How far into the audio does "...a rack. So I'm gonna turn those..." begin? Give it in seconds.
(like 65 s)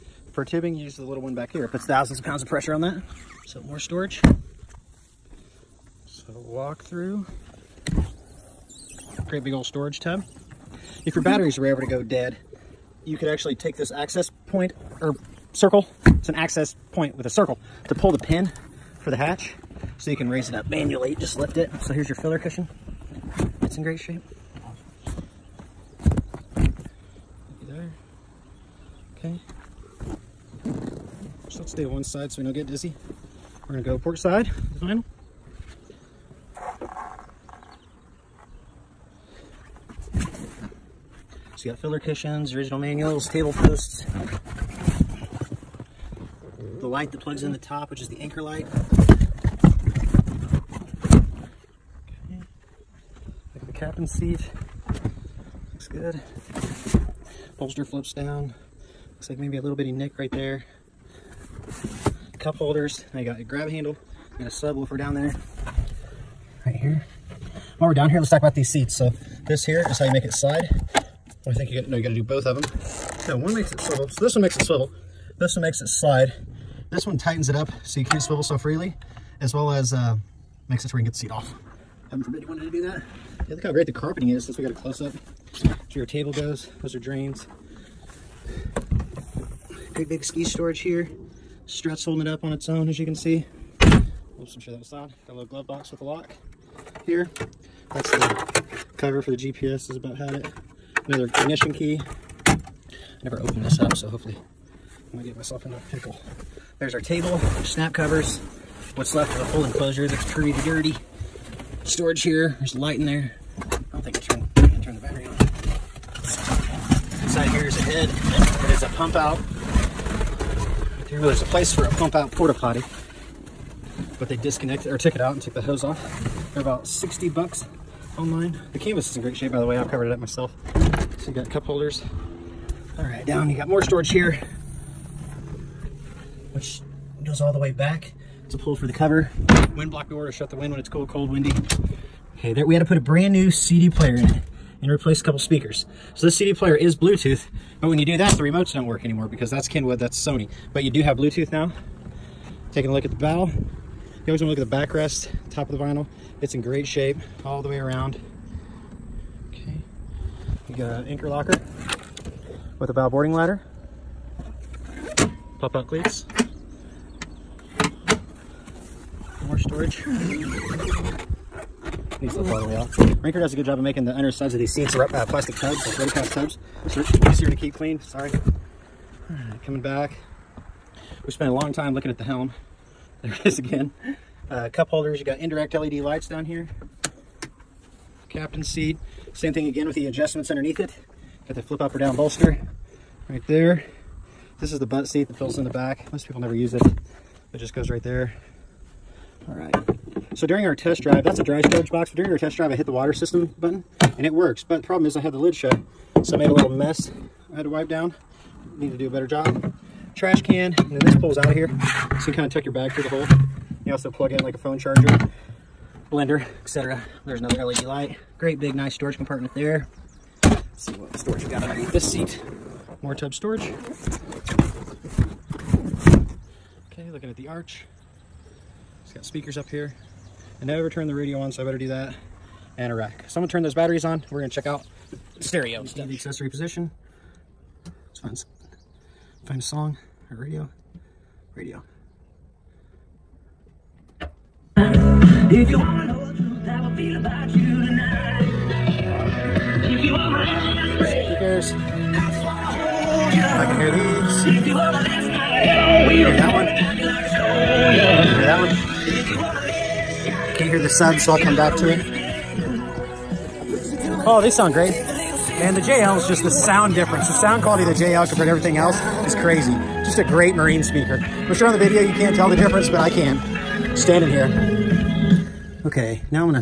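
232 s.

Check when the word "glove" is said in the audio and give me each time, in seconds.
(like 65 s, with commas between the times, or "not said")
95 s.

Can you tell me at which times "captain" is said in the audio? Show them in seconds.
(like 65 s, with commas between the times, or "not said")
53 s, 188 s.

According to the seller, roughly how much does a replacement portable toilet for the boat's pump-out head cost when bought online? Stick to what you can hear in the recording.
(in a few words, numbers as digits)
$60.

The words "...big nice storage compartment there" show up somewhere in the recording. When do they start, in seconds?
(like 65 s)
218 s.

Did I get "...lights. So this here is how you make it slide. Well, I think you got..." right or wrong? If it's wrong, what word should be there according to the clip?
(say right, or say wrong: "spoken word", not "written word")
wrong: "seats", not "lights".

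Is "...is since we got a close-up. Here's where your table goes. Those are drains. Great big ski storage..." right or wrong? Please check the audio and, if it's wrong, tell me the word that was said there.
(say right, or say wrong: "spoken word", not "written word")
right.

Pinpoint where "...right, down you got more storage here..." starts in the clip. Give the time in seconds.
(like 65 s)
133 s.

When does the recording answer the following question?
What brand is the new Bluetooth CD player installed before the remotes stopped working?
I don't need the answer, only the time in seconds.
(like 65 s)
149 s.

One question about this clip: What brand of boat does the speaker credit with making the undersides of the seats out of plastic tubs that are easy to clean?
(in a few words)
Rinker.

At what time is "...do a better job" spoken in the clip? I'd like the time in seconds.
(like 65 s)
208 s.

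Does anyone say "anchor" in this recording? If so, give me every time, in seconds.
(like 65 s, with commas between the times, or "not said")
48 s, 161 s.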